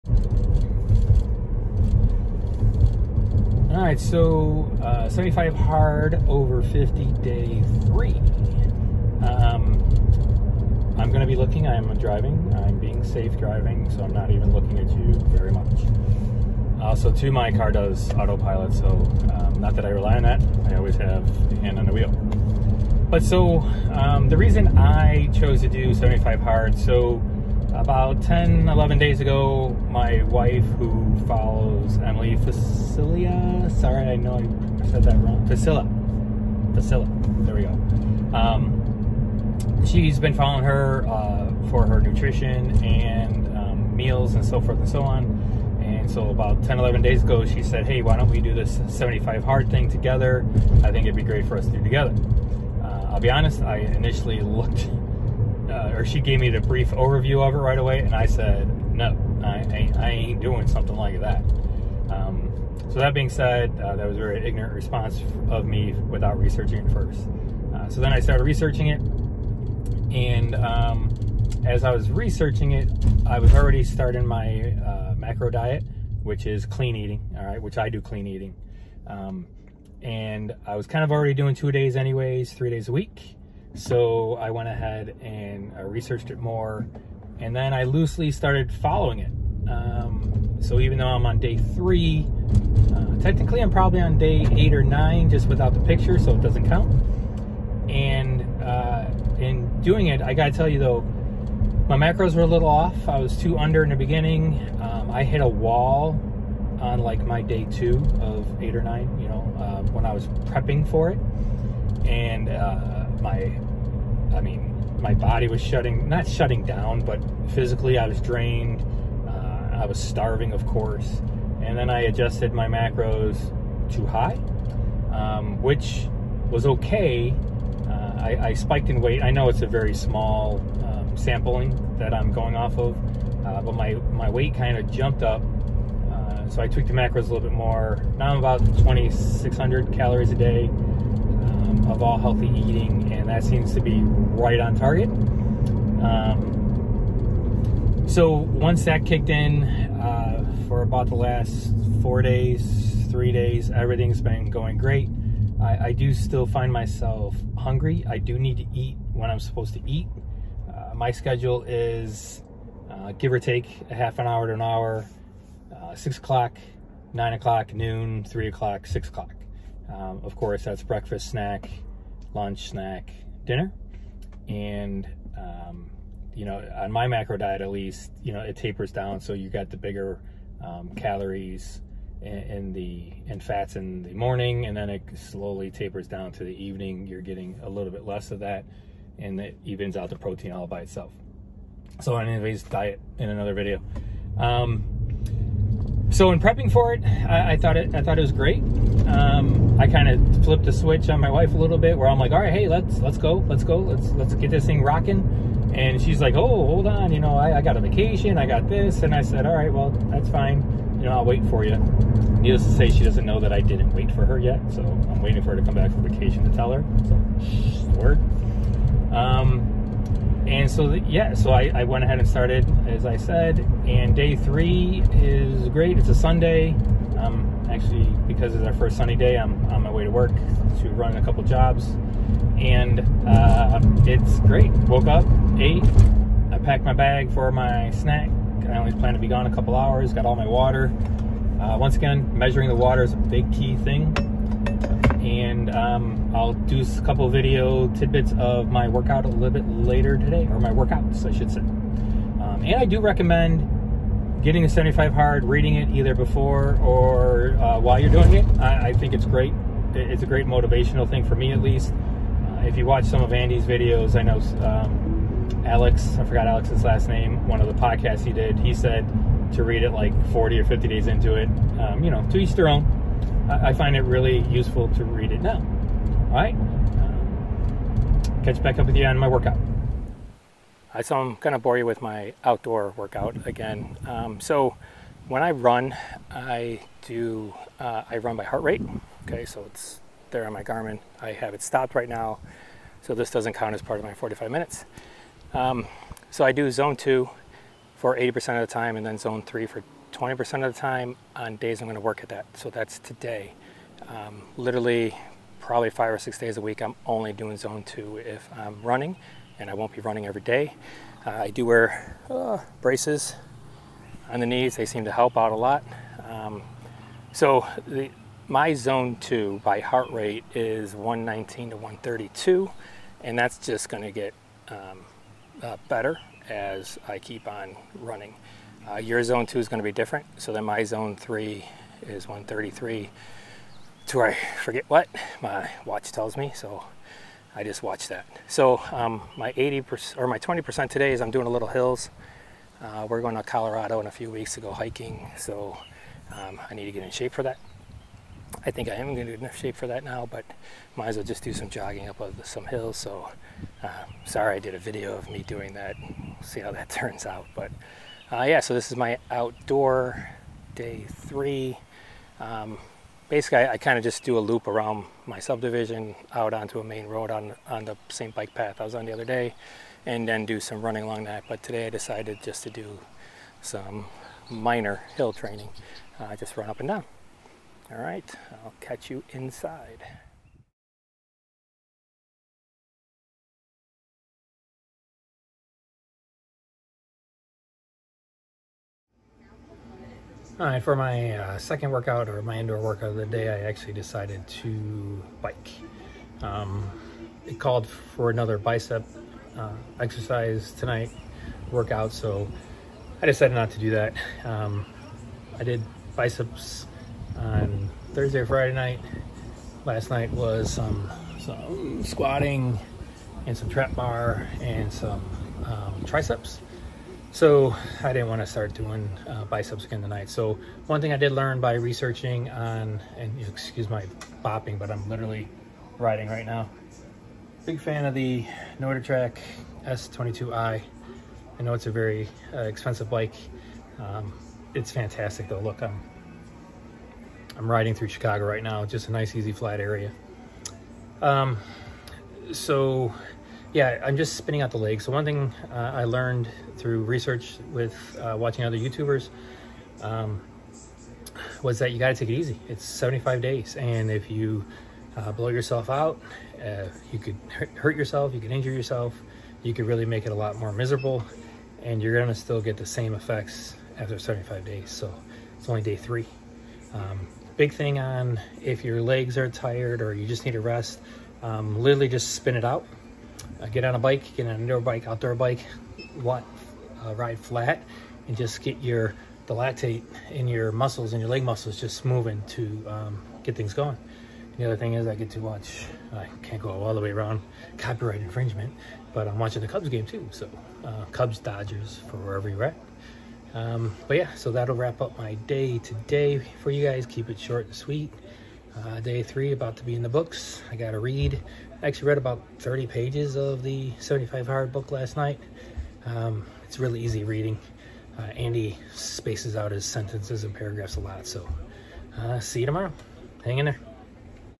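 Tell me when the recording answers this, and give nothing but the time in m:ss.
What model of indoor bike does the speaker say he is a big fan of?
7:09.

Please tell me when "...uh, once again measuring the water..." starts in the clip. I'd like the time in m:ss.
4:01.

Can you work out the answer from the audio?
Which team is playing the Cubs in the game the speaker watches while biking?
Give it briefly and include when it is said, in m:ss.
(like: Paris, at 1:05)
Dodgers, at 8:11.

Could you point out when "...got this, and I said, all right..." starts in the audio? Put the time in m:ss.
3:28.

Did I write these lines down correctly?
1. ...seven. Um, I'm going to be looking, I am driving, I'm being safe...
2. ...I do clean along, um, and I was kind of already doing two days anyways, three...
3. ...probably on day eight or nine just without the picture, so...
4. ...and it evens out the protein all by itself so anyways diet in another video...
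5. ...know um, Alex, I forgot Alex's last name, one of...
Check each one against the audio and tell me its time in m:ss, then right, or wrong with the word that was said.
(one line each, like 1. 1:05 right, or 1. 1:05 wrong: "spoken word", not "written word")
1. 0:07 wrong: "three", not "seven"
2. 1:17 wrong: "eating", not "along"
3. 1:33 right
4. 3:09 right
5. 4:24 right.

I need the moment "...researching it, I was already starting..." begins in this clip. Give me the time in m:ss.
1:12.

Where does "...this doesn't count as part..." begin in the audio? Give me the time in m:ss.
4:53.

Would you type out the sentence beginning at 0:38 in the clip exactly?
Um, she's been following her uh, for her nutrition and um, meals and so forth and so on.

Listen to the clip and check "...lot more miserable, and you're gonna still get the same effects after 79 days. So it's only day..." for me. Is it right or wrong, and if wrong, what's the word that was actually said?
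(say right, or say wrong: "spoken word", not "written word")
wrong: "75", not "79".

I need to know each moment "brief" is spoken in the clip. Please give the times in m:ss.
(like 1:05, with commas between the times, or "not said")
0:56.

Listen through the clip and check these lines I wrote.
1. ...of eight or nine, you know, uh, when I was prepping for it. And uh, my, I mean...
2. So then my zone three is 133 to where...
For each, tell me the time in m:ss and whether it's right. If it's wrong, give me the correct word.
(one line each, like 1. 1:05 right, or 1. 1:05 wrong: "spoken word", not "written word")
1. 1:48 right
2. 5:30 right.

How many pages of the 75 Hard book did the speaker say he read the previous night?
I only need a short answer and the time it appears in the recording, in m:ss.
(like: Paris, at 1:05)
30, at 8:22.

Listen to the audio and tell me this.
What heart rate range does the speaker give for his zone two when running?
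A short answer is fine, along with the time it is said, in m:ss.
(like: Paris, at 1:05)
119 to 132, at 5:20.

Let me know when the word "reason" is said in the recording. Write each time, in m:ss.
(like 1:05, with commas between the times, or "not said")
0:24.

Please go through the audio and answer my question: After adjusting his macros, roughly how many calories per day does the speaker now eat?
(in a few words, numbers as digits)
2,600.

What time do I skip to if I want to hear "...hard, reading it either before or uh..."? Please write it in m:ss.
4:15.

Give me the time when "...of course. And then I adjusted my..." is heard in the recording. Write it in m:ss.
2:00.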